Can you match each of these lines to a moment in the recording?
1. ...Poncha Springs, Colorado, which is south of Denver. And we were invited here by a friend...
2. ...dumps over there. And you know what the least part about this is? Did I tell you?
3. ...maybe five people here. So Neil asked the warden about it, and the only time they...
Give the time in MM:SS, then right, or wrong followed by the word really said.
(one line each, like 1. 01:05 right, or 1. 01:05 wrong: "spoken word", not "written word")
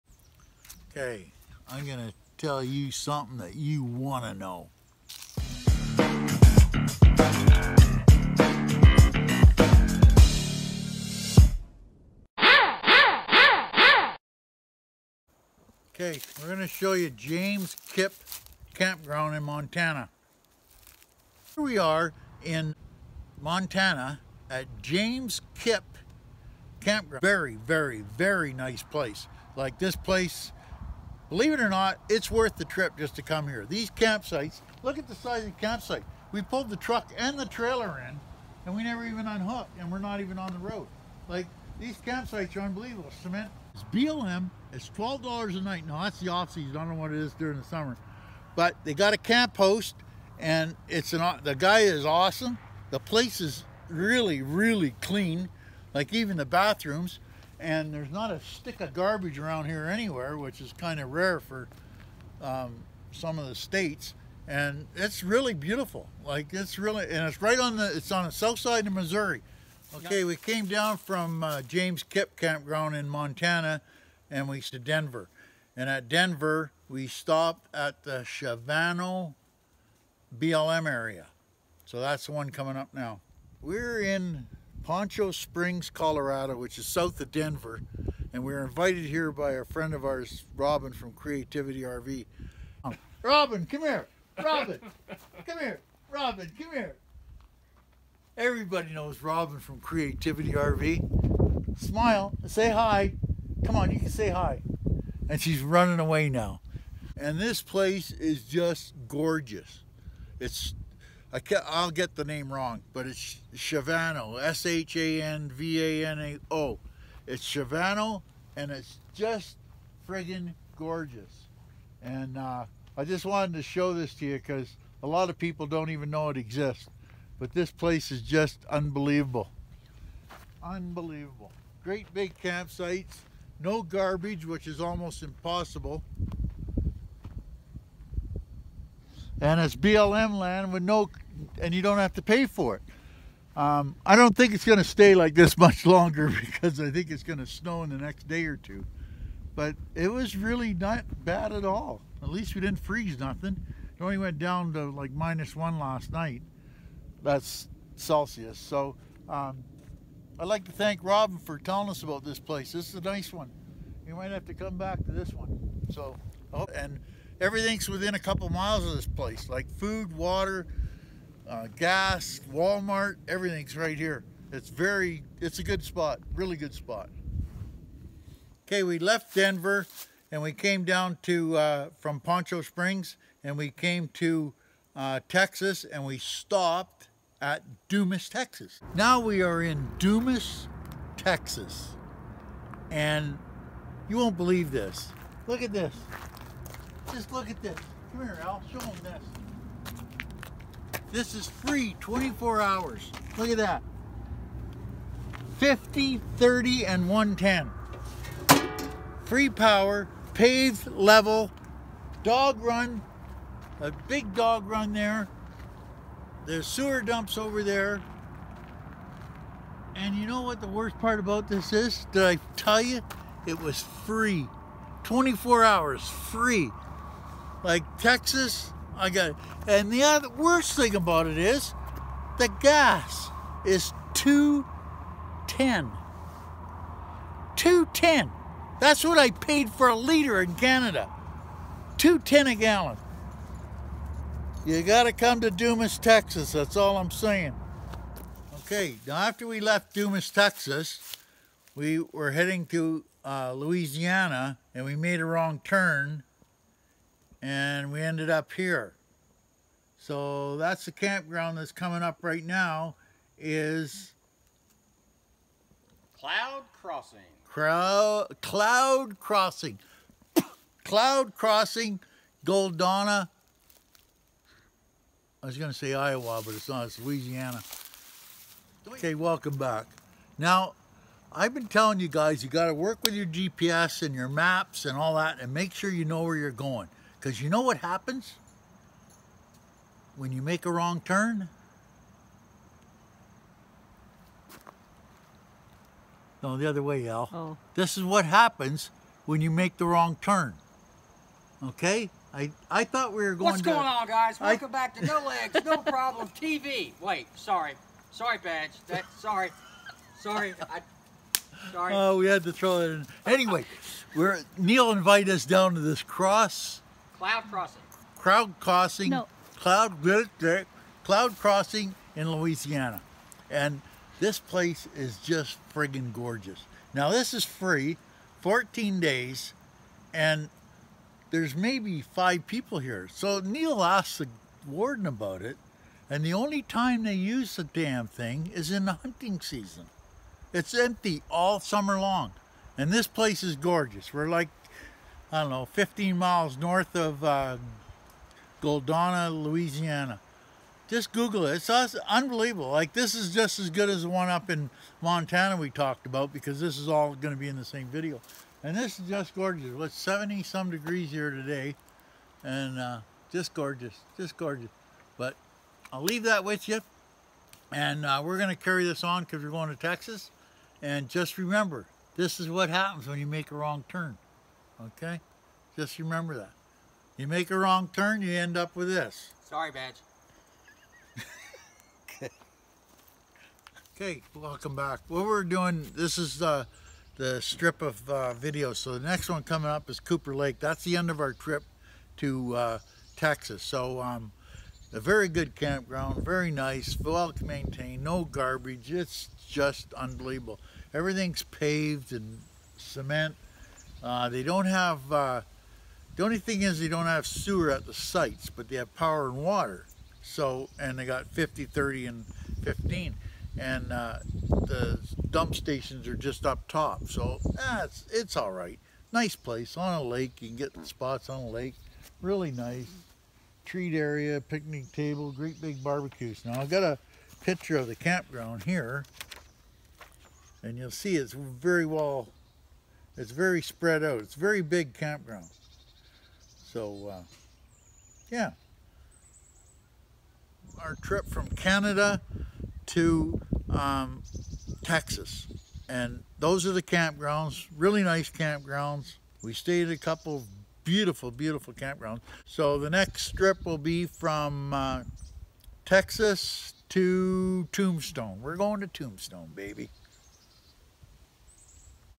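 1. 01:24 right
2. 03:37 wrong: "worst", not "least"
3. 05:31 right.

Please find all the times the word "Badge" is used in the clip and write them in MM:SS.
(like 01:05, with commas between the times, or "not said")
05:08, 06:19.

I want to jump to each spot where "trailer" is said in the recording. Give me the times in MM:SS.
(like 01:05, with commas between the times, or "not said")
00:37.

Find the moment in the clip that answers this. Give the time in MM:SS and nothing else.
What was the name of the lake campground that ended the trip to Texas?
06:29.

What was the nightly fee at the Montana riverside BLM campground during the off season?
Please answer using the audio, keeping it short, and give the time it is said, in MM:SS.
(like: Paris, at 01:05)
$12, at 00:44.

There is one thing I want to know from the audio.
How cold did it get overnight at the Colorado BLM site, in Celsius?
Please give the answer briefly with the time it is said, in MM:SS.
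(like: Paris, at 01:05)
minus 1, at 02:35.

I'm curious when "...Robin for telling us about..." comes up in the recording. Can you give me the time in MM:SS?
02:41.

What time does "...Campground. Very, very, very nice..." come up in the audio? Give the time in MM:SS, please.
00:26.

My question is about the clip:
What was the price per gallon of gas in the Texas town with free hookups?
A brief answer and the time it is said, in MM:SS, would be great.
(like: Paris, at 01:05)
2.10, at 04:01.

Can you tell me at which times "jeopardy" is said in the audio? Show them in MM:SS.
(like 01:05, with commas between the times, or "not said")
not said.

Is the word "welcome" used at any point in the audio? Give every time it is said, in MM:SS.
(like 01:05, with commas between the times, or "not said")
04:39, 05:04, 06:24.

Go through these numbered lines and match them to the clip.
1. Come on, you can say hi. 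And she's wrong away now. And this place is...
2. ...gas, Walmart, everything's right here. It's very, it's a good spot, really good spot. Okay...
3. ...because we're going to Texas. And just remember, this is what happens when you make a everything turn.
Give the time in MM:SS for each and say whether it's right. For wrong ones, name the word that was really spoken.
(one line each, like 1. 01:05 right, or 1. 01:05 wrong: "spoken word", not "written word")
1. 01:43 wrong: "running", not "wrong"
2. 02:51 right
3. 06:09 wrong: "wrong", not "everything".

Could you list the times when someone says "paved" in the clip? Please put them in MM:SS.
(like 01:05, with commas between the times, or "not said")
03:30, 06:41.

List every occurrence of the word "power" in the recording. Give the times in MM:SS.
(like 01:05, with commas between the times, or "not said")
03:29, 06:48.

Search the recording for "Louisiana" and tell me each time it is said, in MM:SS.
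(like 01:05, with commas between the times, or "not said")
04:13, 04:36, 05:22, 05:49.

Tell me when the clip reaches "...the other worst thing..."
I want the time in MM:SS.
03:49.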